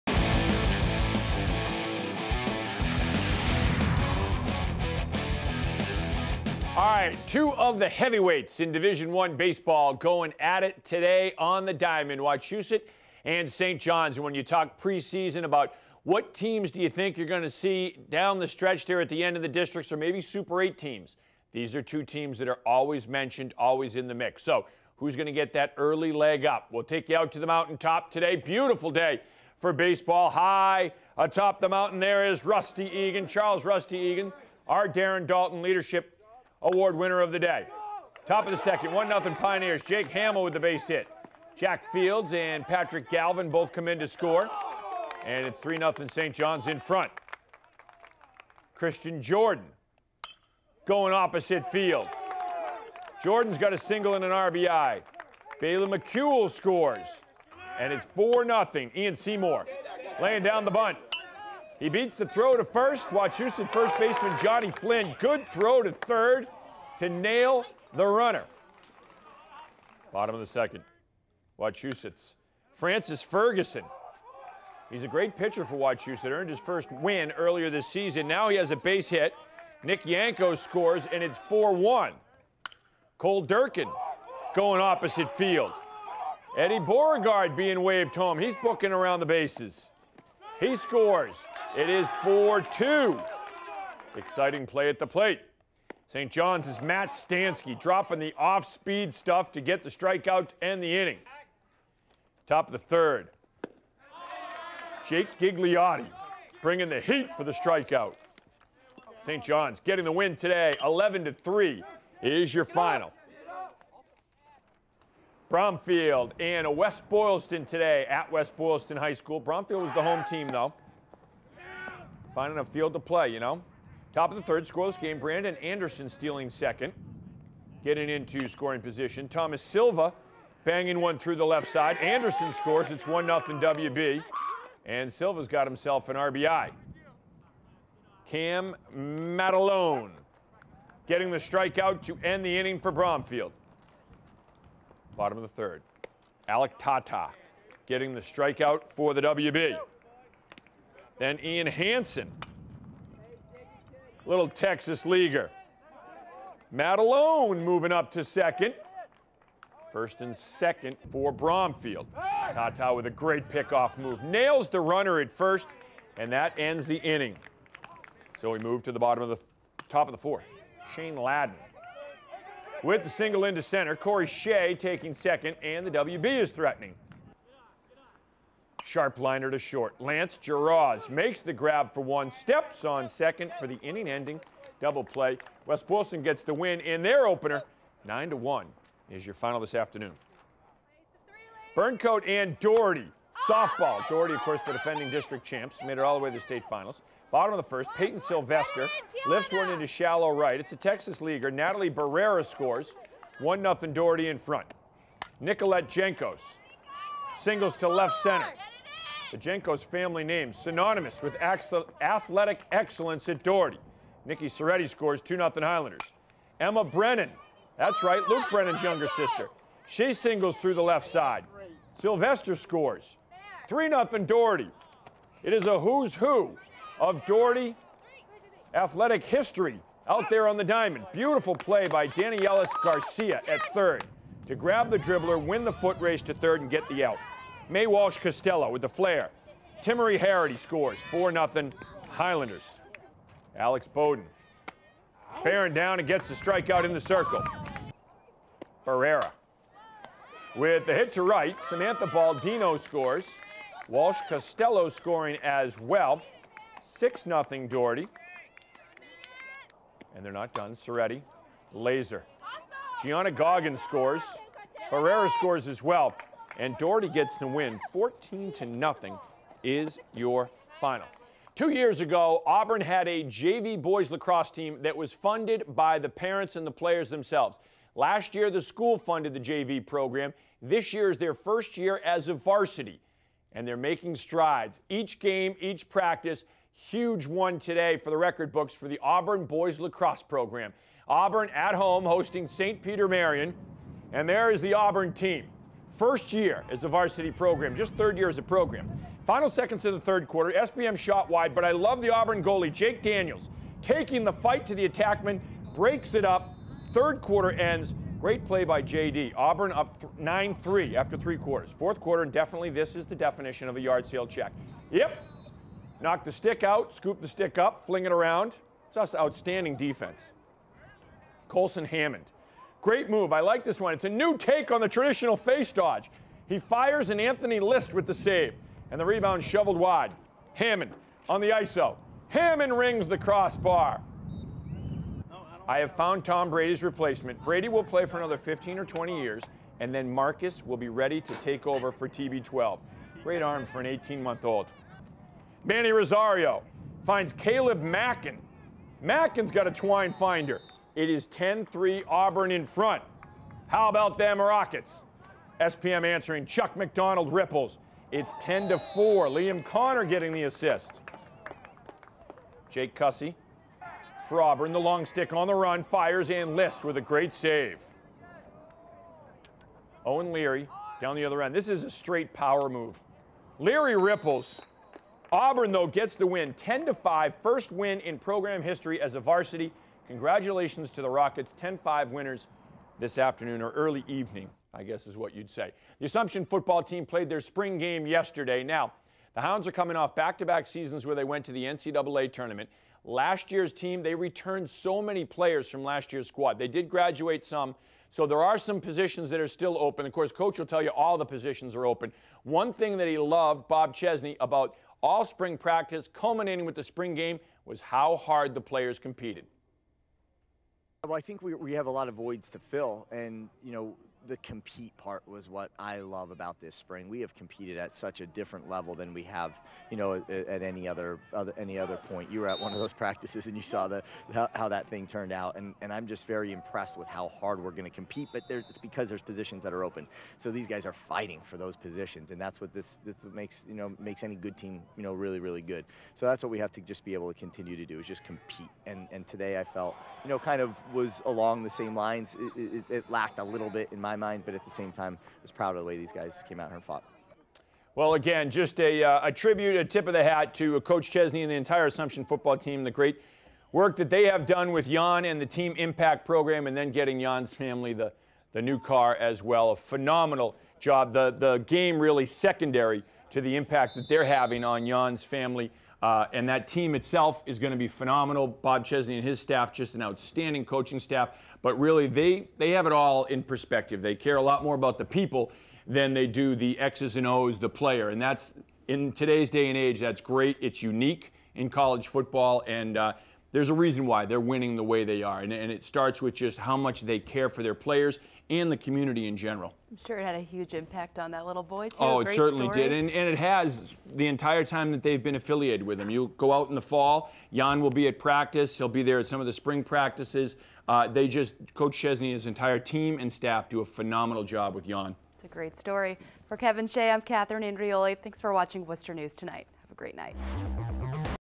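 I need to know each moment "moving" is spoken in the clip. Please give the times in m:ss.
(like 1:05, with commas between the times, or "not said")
2:37.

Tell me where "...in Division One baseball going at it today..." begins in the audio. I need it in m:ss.
0:08.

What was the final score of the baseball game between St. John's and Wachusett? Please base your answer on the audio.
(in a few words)
11 to 3.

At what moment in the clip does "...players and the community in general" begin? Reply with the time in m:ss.
8:07.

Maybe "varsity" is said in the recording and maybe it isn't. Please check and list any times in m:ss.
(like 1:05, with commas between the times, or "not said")
4:42, 4:56, 6:19.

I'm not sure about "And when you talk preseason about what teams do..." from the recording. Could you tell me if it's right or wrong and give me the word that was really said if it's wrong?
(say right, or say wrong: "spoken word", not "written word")
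right.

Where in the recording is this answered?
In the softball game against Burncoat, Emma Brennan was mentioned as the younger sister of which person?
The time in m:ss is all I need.
3:38.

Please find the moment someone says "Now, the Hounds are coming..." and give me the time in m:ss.
6:28.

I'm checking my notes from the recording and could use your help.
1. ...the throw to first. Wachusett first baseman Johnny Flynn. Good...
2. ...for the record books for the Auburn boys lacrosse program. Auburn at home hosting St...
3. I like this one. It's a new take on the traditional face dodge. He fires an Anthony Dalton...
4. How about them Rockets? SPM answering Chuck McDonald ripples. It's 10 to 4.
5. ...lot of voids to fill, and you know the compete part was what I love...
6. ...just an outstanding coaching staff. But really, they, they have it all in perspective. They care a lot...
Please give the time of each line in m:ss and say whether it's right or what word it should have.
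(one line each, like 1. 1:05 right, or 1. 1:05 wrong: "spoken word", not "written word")
1. 1:02 right
2. 4:47 right
3. 5:23 wrong: "List", not "Dalton"
4. 5:53 right
5. 6:51 right
6. 7:49 right.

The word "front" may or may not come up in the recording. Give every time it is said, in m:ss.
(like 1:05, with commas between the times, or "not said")
0:46, 3:24, 5:52.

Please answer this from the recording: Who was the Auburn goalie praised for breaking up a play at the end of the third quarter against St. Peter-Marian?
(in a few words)
Jake Daniels.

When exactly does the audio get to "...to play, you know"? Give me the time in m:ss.
2:02.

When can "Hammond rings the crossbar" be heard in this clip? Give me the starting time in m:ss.
5:32.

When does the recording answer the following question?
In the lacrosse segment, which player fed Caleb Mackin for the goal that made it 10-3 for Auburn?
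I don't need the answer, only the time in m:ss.
5:45.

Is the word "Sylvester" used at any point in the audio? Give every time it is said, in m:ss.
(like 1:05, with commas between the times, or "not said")
3:18, 3:41.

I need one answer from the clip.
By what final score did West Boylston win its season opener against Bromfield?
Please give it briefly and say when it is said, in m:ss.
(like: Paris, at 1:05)
9 to 1, at 3:08.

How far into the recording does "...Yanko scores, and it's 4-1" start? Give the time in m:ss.
1:20.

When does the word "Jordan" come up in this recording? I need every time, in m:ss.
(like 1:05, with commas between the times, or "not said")
0:49, 0:53.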